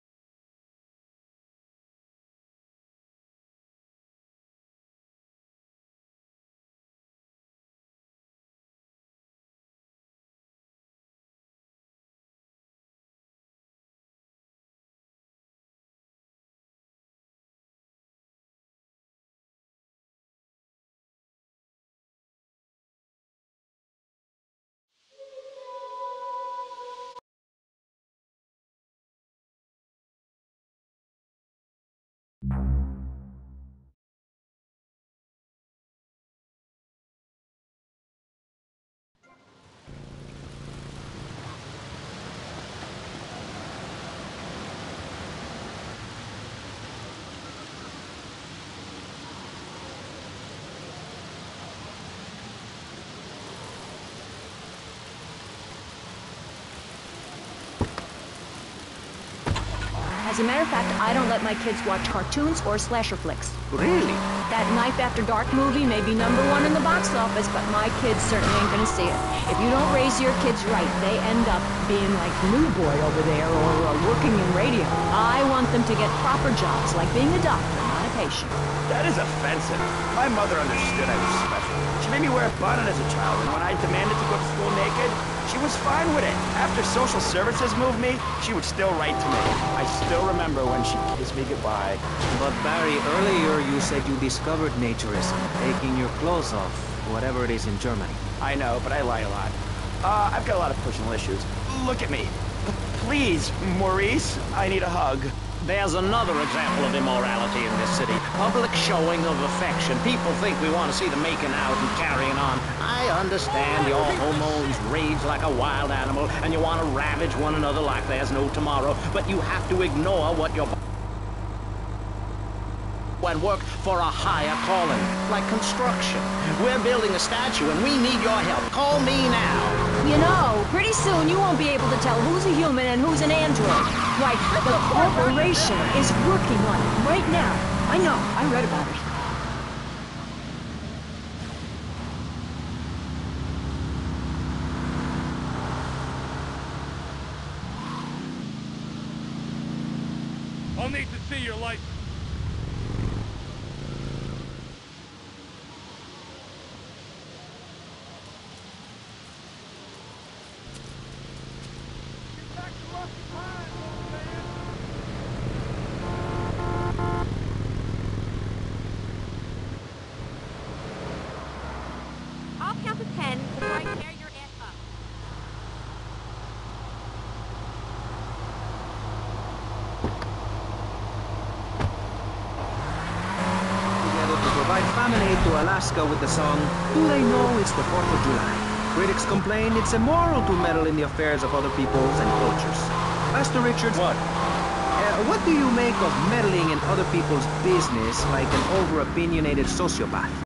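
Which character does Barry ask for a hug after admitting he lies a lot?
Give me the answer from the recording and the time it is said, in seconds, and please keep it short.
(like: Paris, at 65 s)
Maurice, at 103 s.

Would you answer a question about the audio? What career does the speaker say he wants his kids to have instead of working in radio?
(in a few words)
Doctor.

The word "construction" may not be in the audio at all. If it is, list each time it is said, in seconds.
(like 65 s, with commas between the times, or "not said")
125 s.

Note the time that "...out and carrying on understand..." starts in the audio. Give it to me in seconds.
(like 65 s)
111 s.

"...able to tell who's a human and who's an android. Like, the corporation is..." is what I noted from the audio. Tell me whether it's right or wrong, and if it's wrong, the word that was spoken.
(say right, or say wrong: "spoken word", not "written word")
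right.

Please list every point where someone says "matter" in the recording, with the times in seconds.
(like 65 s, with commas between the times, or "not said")
60 s.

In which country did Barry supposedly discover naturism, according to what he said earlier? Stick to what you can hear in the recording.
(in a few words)
Germany.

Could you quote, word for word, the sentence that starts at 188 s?
Critics complain it's immoral to meddle in the affairs of other peoples and cultures.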